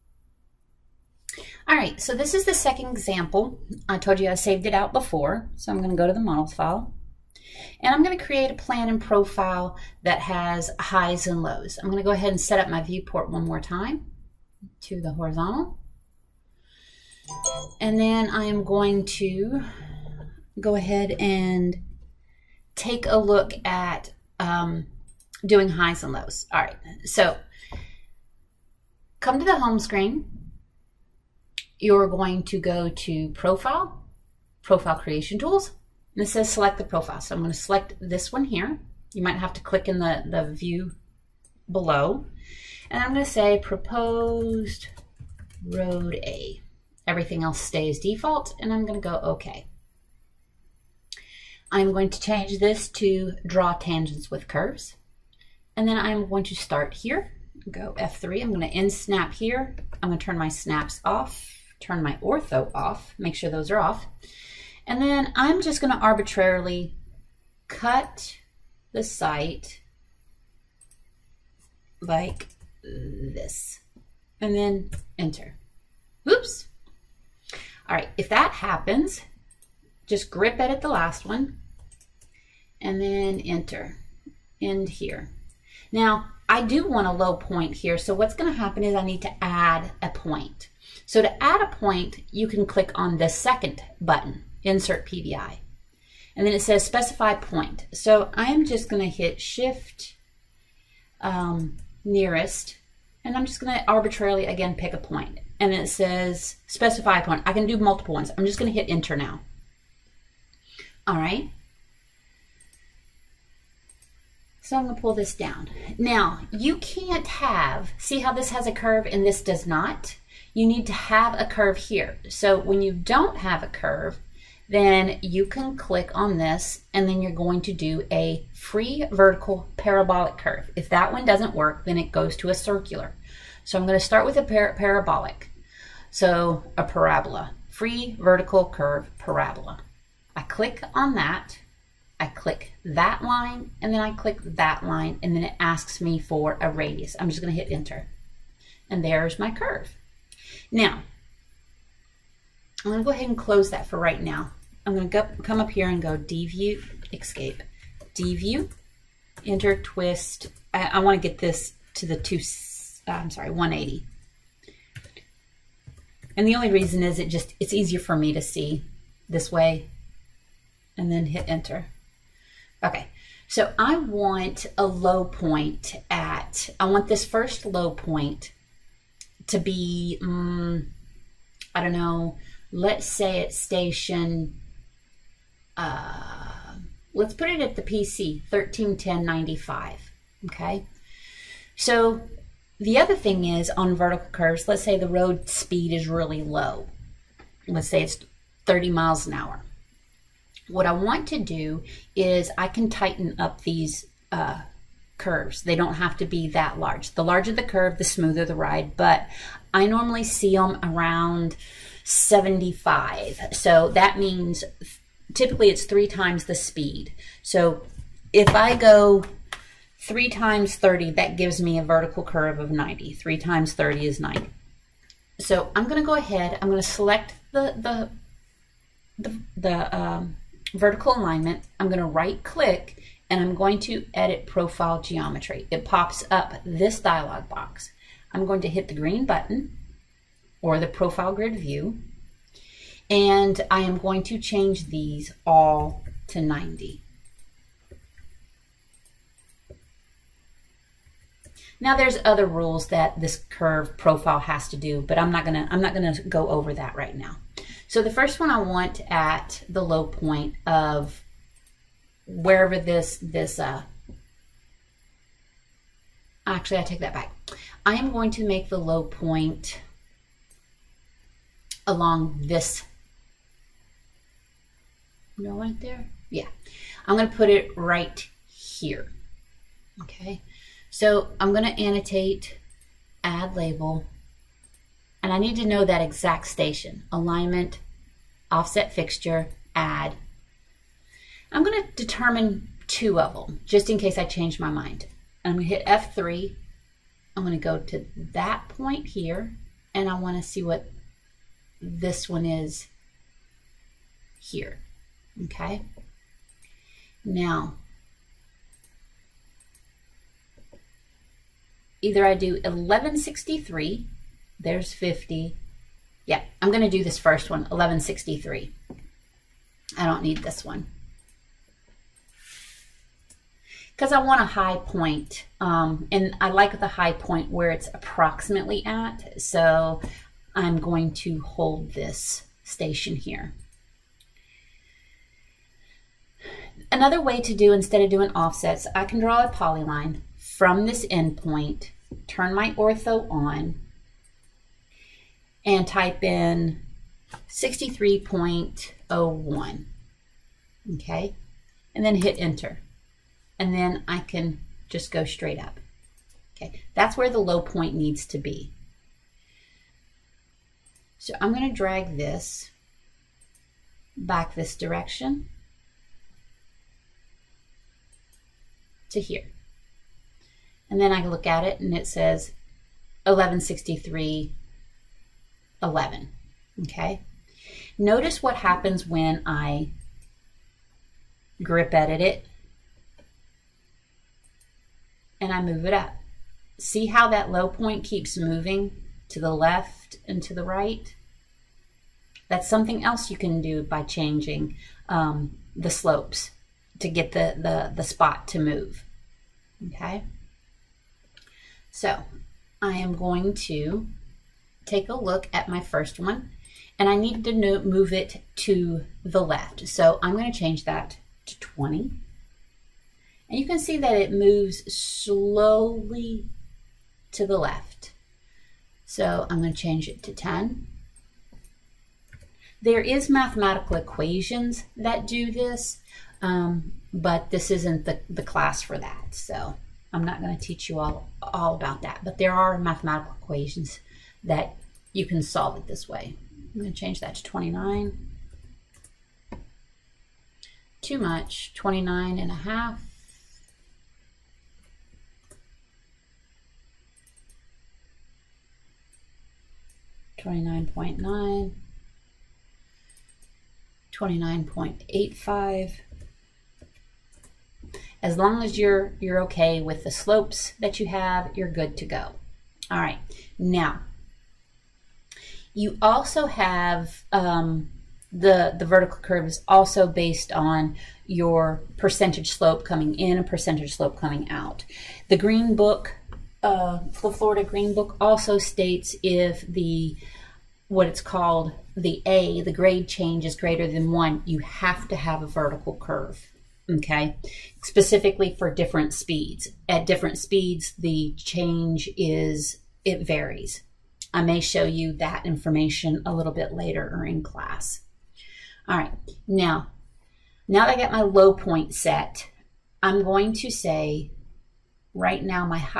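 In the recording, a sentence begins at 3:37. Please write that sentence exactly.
So if I go three times 30, that gives me a vertical curve of 90.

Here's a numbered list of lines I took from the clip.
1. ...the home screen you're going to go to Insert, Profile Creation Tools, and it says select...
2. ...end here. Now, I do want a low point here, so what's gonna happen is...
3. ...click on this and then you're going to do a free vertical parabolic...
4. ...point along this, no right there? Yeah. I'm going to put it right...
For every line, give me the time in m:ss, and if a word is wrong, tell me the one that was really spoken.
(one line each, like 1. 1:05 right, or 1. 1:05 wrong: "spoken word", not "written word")
1. 0:29 wrong: "Profile", not "Insert"
2. 1:24 right
3. 2:05 right
4. 4:29 right.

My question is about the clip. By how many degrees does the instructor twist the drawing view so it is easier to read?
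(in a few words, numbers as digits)
180.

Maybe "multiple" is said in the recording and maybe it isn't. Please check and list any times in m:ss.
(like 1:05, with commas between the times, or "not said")
1:47.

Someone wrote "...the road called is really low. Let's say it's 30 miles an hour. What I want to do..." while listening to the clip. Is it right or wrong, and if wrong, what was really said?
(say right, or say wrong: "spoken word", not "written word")
wrong: "speed", not "called".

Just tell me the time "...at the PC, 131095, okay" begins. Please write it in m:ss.
3:07.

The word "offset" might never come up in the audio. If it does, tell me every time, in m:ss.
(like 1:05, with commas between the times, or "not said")
4:48, 5:38.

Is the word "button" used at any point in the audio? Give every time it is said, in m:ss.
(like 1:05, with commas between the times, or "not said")
1:33, 3:59.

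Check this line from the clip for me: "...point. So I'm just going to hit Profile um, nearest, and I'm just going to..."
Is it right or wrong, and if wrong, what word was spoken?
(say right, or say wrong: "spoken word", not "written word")
wrong: "Shift", not "Profile".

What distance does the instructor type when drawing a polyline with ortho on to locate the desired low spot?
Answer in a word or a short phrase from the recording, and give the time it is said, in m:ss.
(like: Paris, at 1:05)
63.01, at 5:47.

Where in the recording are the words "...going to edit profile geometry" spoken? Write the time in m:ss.
3:53.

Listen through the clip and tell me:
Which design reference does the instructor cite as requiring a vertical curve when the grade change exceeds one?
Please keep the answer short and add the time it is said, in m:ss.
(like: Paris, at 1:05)
Florida Green Book, at 7:57.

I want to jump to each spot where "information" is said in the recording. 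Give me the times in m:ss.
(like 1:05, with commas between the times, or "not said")
8:15.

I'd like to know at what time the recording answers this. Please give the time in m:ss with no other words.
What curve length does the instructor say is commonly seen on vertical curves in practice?
3:30.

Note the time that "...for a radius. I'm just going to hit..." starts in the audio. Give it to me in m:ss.
2:26.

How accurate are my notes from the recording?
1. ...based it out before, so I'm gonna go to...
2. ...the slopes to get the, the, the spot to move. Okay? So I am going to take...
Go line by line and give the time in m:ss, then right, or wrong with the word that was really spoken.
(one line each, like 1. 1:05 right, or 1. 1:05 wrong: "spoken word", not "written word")
1. 0:04 wrong: "saved", not "based"
2. 6:35 right.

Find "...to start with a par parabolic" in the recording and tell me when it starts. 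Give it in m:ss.
2:13.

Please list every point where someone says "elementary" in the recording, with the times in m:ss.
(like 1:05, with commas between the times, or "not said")
not said.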